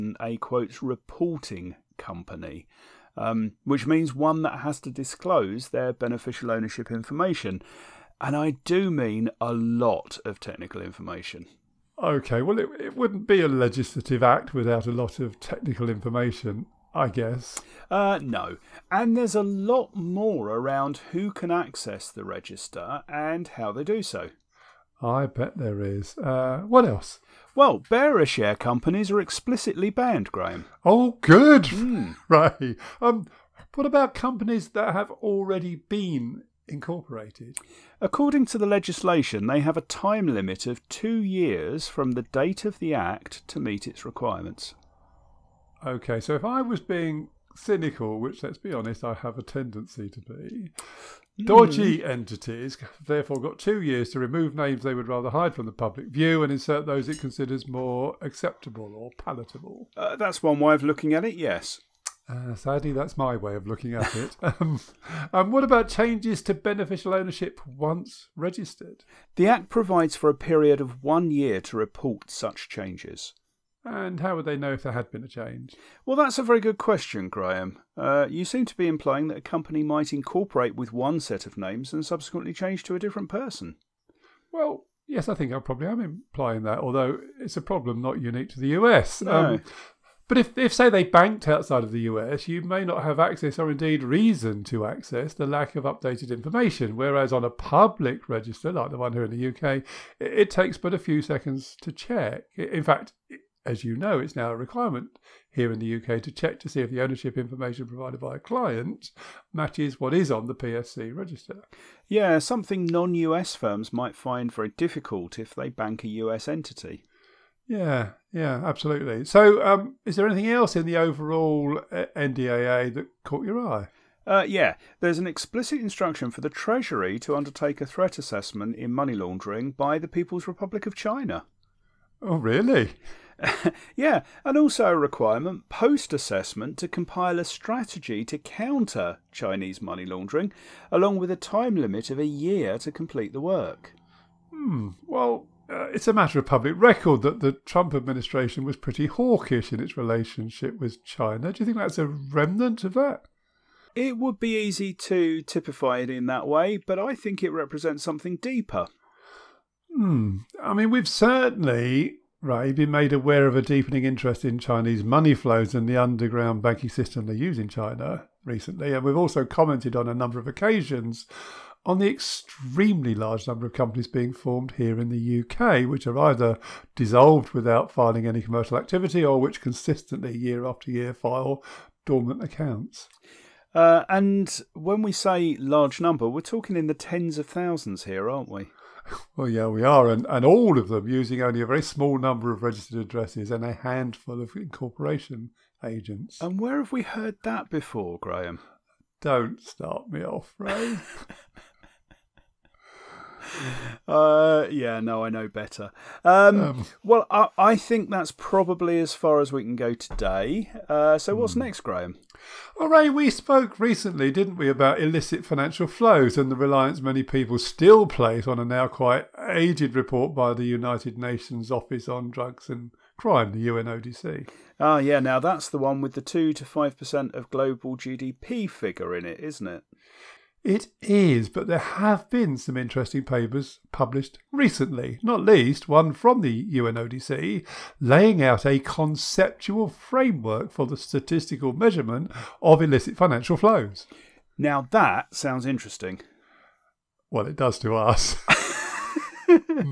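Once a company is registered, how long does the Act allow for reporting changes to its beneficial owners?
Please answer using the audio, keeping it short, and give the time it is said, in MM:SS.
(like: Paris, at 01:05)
1 year, at 01:11.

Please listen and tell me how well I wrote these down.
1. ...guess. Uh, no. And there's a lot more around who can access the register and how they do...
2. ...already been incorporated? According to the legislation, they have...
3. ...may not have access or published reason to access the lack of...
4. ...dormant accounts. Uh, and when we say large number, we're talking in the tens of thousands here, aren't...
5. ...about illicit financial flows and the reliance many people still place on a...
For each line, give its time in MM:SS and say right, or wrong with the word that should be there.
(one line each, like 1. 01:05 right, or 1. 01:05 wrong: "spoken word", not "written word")
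1. 00:17 right
2. 00:35 right
3. 01:32 wrong: "indeed", not "published"
4. 03:02 right
5. 03:34 right.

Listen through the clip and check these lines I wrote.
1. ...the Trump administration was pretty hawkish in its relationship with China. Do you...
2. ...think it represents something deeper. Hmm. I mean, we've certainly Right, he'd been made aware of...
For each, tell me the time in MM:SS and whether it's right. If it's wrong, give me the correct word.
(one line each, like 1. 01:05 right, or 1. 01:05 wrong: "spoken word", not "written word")
1. 02:27 right
2. 02:37 right.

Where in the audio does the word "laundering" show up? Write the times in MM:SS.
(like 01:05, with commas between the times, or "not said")
02:09, 02:20.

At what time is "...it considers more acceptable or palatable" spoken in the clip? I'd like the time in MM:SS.
00:57.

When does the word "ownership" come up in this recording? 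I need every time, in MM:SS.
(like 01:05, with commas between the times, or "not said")
00:06, 01:07, 01:47.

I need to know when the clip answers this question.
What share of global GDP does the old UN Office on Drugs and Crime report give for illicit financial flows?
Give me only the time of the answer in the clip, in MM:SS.
03:46.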